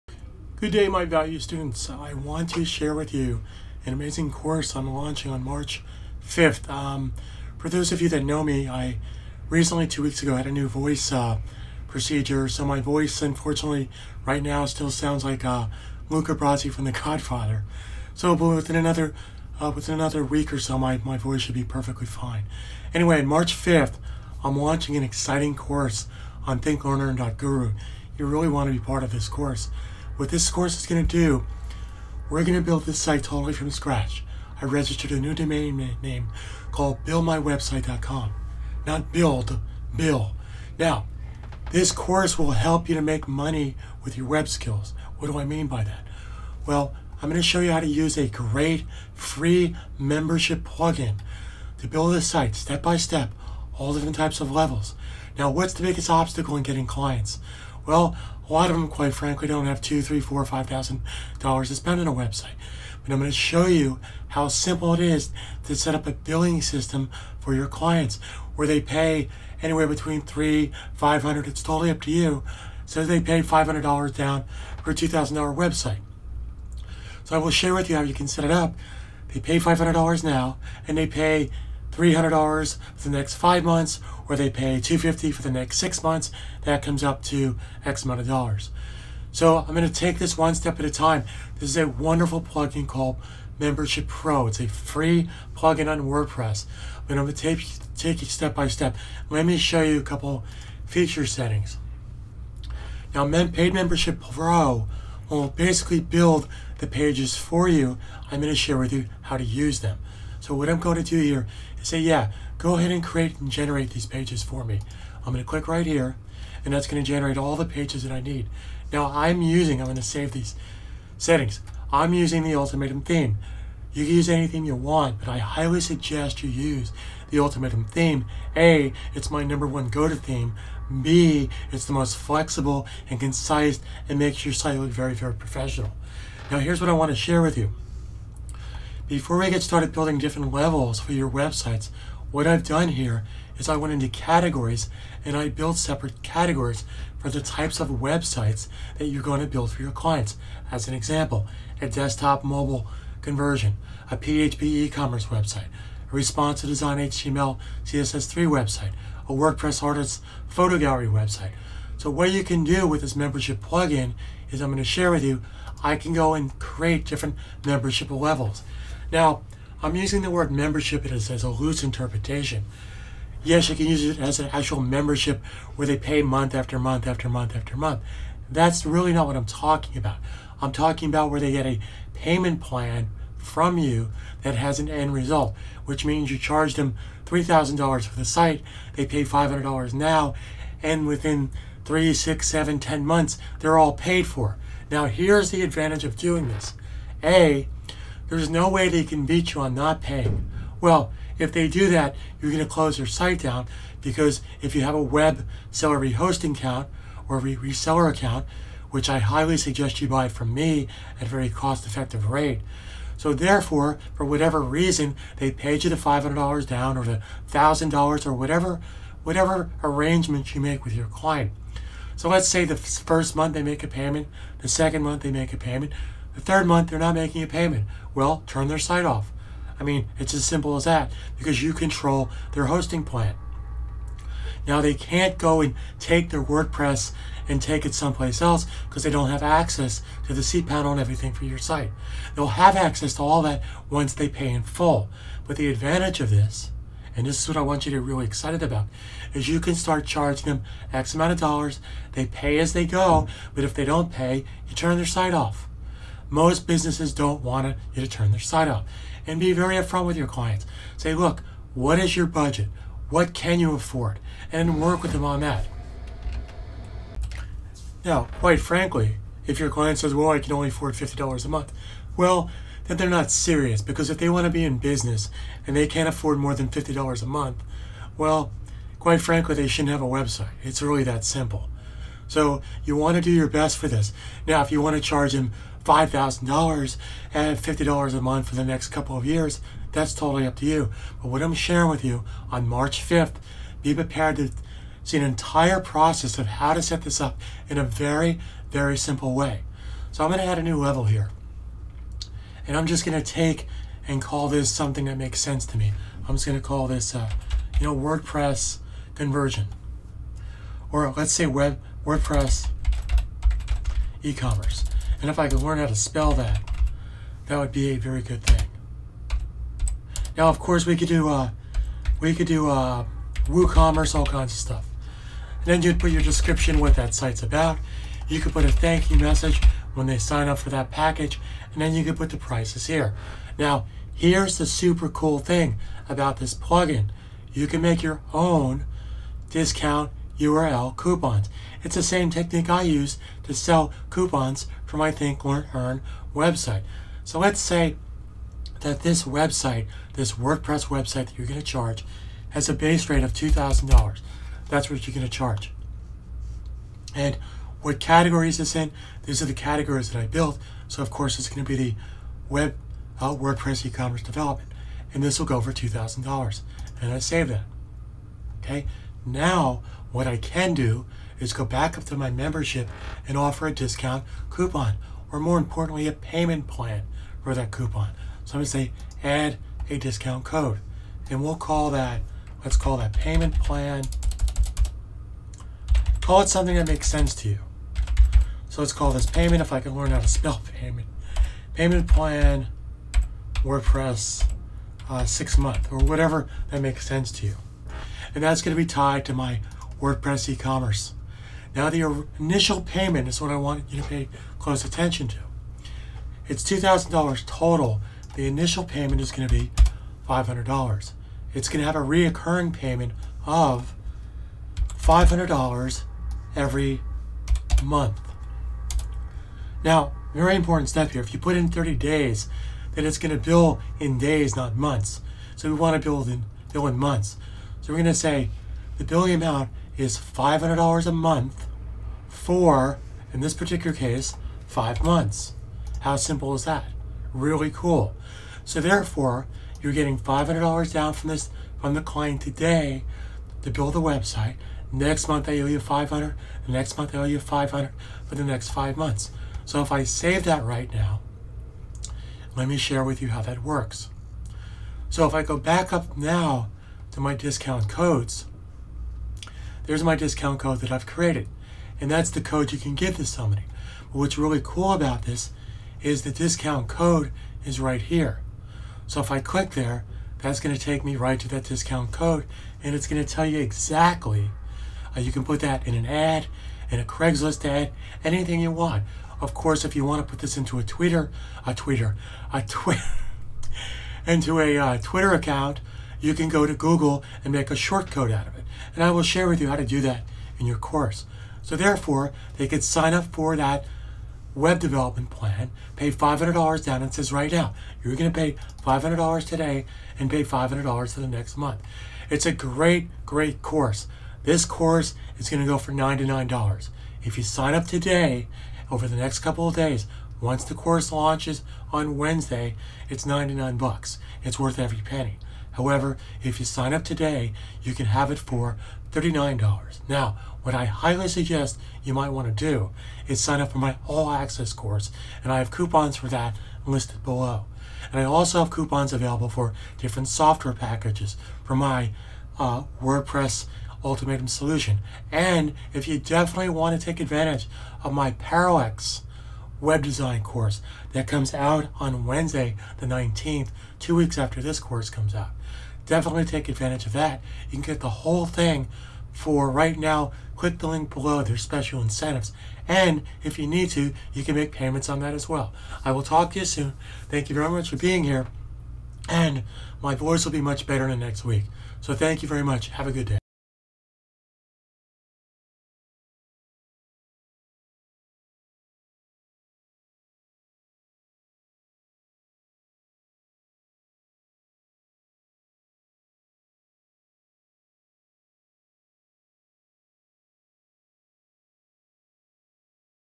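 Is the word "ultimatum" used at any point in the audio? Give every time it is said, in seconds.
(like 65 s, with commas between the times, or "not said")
122 s, 127 s, 534 s.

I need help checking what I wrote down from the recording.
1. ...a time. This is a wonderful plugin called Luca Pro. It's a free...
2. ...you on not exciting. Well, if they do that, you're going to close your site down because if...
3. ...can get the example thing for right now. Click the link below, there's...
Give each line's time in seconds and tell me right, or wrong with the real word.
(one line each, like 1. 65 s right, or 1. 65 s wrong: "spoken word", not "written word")
1. 90 s wrong: "Membership", not "Luca"
2. 199 s wrong: "paying", not "exciting"
3. 547 s wrong: "whole", not "example".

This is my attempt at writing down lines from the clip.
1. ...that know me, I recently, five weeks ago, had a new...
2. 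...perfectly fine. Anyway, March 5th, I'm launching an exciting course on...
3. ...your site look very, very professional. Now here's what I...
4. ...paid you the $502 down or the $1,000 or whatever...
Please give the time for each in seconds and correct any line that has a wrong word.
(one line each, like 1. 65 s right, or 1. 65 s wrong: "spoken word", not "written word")
1. 8 s wrong: "two", not "five"
2. 21 s right
3. 134 s right
4. 215 s wrong: "500", not "502".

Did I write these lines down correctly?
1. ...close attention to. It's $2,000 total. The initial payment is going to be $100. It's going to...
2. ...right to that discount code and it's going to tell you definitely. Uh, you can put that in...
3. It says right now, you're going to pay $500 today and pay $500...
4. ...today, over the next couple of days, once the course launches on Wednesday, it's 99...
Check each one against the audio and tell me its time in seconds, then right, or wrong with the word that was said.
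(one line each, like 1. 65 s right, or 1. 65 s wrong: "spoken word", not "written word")
1. 404 s wrong: "500", not "100"
2. 471 s wrong: "exactly", not "definitely"
3. 497 s right
4. 507 s right.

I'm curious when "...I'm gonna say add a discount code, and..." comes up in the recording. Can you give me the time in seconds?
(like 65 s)
378 s.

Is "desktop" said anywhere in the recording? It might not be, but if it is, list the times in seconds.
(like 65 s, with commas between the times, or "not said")
151 s.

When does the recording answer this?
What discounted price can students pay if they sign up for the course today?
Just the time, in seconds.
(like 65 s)
519 s.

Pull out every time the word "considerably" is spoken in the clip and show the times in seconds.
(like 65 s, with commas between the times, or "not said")
not said.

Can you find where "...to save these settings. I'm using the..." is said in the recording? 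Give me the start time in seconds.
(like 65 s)
119 s.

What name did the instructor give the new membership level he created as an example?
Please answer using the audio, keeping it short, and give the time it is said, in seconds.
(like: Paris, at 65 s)
web WordPress e-commerce, at 311 s.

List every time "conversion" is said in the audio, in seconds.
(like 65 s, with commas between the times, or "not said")
153 s, 309 s.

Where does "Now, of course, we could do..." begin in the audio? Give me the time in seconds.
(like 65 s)
320 s.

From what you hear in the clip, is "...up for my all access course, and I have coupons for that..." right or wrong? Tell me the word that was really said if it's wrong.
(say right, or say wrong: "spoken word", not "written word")
right.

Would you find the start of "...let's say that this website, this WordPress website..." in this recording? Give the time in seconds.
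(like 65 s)
347 s.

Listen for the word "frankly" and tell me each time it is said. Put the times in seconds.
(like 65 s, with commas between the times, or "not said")
59 s, 268 s, 279 s.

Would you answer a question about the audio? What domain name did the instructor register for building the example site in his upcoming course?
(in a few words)
billmywebsite.com.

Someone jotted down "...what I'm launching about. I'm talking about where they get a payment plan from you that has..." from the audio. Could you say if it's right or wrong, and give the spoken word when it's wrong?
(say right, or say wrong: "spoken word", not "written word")
wrong: "talking", not "launching".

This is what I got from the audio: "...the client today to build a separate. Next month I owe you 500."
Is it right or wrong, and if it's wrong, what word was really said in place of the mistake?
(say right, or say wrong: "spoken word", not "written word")
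wrong: "website", not "separate".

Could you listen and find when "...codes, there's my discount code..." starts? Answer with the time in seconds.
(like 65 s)
457 s.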